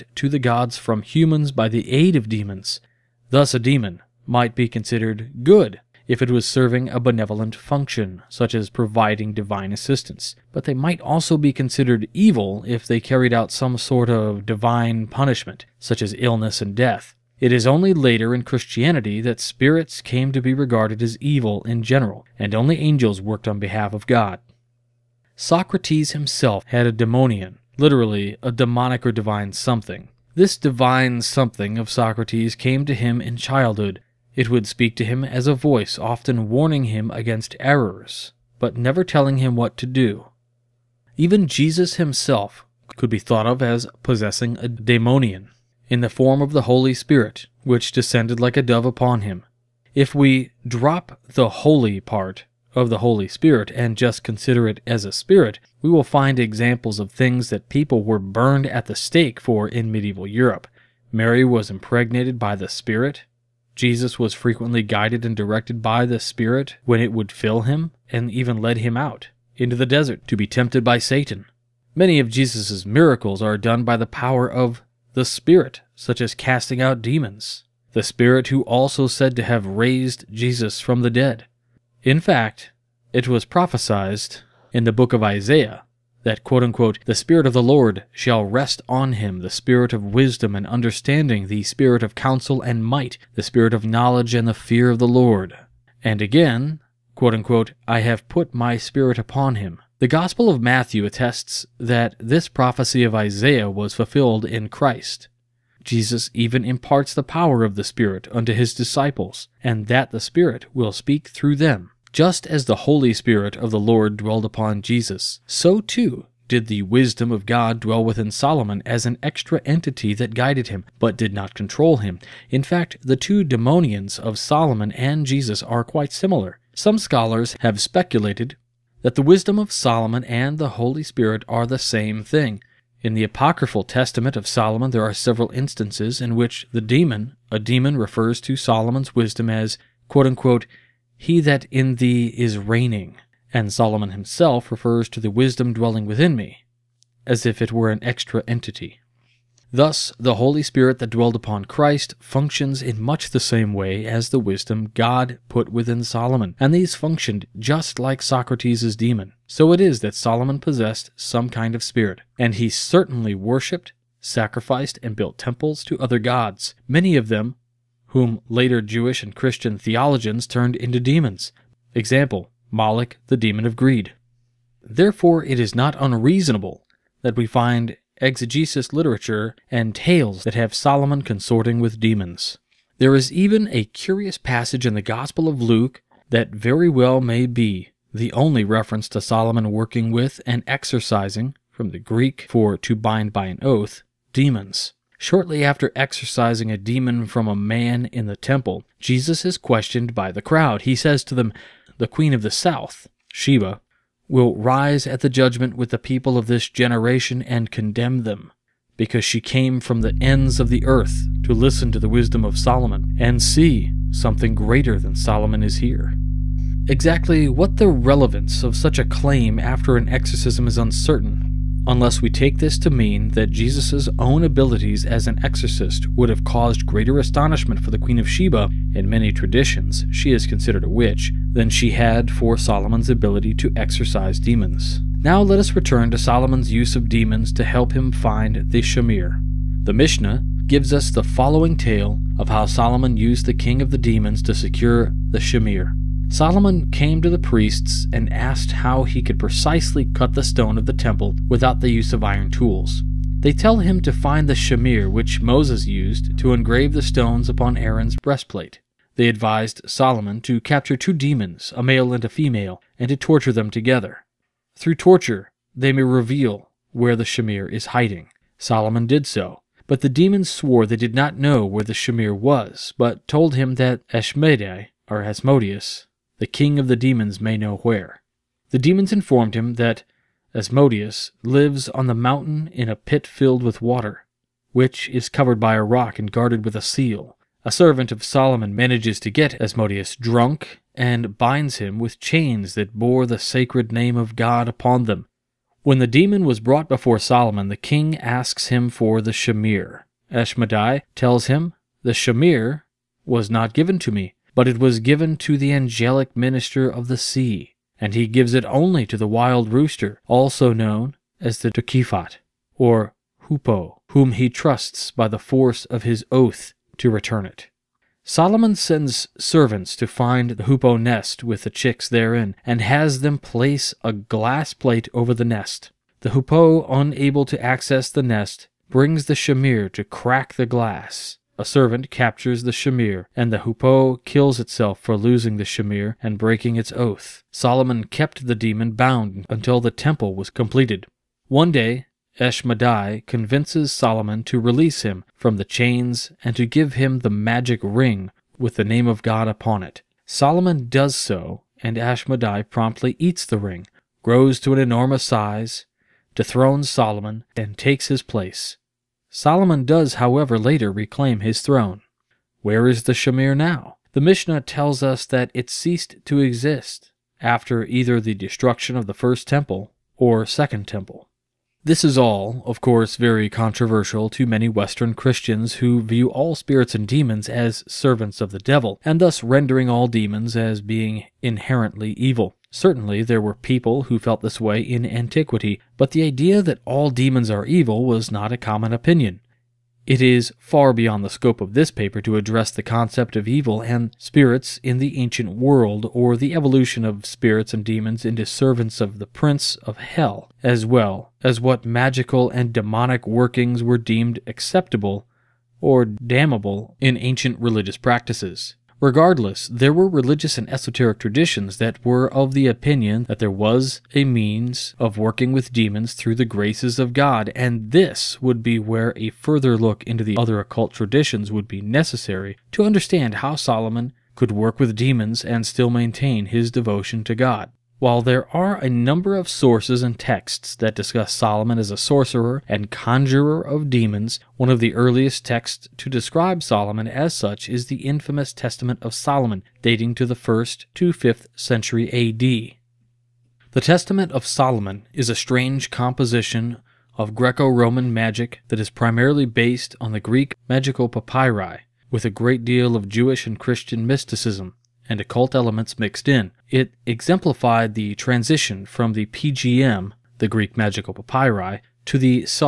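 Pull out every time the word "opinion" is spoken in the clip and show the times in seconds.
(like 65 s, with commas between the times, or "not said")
388 s, 412 s.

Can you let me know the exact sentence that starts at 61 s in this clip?
Mary was impregnated by the Spirit.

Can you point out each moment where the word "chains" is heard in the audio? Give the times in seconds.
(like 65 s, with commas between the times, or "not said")
292 s, 345 s.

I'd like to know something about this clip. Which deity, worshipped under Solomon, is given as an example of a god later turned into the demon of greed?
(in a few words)
Moloch.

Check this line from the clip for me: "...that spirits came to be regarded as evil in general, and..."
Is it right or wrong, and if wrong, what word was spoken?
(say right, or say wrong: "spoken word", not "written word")
right.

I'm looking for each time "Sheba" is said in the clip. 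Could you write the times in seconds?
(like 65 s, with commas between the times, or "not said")
203 s, 228 s.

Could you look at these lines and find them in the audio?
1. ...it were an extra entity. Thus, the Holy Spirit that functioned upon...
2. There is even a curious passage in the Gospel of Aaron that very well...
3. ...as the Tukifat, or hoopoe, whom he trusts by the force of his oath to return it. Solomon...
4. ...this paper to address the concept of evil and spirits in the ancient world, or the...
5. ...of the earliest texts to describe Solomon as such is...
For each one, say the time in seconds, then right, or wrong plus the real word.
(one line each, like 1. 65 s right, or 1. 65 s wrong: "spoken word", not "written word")
1. 147 s wrong: "dwelled", not "functioned"
2. 182 s wrong: "Luke", not "Aaron"
3. 311 s right
4. 391 s right
5. 434 s right.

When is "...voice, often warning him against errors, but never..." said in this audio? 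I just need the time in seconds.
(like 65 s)
35 s.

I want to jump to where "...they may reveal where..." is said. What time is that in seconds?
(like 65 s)
265 s.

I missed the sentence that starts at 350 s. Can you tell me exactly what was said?
Solomon does so, and Ashmedai promptly eats the ring, grows to an enormous size, dethrones Solomon, and takes his place.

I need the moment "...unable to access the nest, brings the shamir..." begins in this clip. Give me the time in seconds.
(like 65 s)
326 s.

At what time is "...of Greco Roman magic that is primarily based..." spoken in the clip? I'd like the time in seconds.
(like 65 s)
447 s.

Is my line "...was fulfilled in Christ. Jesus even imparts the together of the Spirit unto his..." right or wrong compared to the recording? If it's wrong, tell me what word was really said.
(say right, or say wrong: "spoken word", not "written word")
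wrong: "power", not "together".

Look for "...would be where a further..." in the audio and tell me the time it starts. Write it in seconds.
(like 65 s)
418 s.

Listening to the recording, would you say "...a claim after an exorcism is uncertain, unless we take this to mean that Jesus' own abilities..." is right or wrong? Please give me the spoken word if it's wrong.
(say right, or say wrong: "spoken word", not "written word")
right.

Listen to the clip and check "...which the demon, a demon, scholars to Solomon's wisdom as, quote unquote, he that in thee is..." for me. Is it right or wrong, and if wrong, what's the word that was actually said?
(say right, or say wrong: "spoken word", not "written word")
wrong: "refers", not "scholars".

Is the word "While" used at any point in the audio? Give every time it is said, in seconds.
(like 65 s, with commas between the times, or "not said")
427 s.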